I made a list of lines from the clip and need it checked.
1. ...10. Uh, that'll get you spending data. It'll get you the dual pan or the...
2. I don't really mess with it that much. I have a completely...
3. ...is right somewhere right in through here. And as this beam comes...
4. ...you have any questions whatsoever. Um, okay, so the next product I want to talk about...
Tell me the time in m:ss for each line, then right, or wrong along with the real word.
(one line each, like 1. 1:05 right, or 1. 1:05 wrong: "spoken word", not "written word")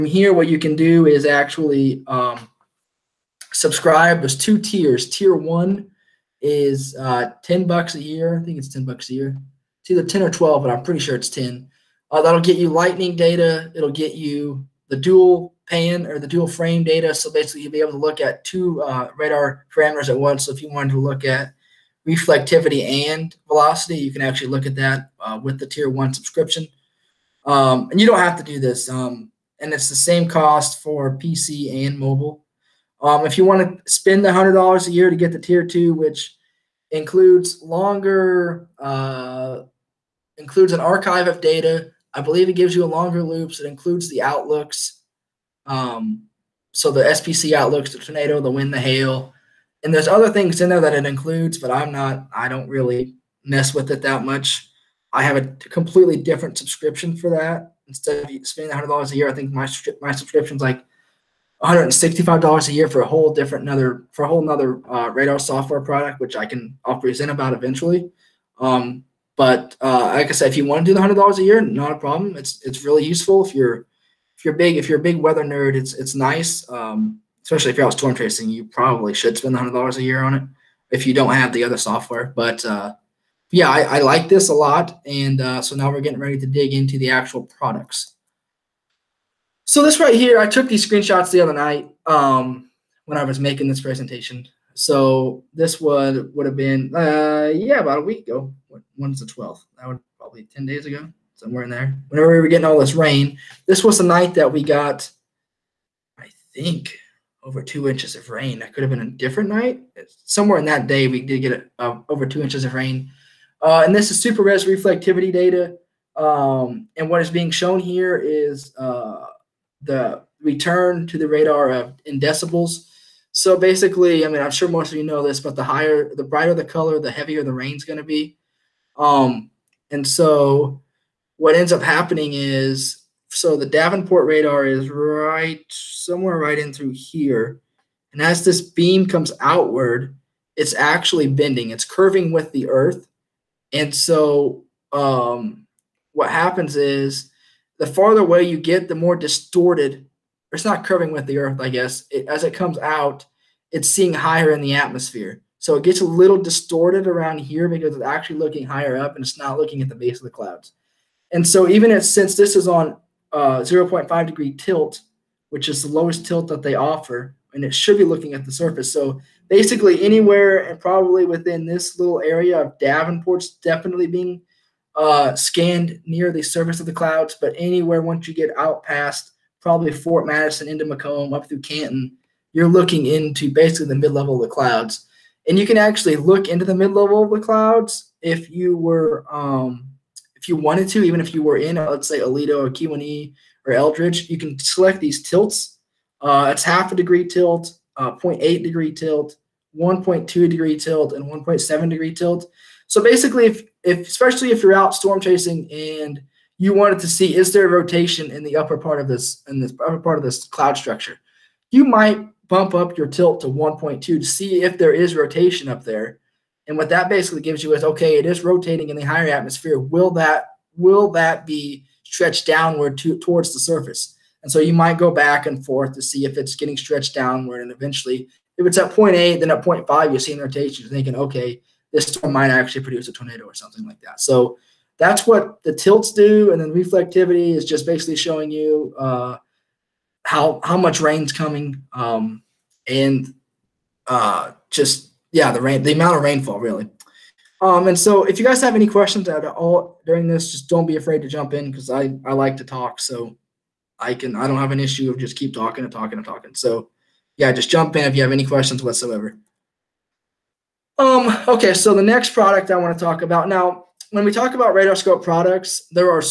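1. 0:11 wrong: "lightning", not "spending"
2. 0:52 right
3. 2:14 right
4. 4:18 right.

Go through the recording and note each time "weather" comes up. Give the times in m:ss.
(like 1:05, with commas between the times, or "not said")
1:15.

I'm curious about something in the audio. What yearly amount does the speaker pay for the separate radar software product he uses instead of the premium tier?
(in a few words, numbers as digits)
$165.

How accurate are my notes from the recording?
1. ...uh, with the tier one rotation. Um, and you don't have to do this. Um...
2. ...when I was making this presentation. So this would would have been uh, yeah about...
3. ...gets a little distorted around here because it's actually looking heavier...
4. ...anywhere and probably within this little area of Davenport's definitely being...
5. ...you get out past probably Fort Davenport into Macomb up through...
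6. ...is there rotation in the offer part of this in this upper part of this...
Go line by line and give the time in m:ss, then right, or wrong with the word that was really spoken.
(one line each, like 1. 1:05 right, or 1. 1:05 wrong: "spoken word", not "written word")
1. 0:25 wrong: "subscription", not "rotation"
2. 1:33 right
3. 2:35 wrong: "higher", not "heavier"
4. 2:50 right
5. 2:58 wrong: "Madison", not "Davenport"
6. 3:27 wrong: "upper", not "offer".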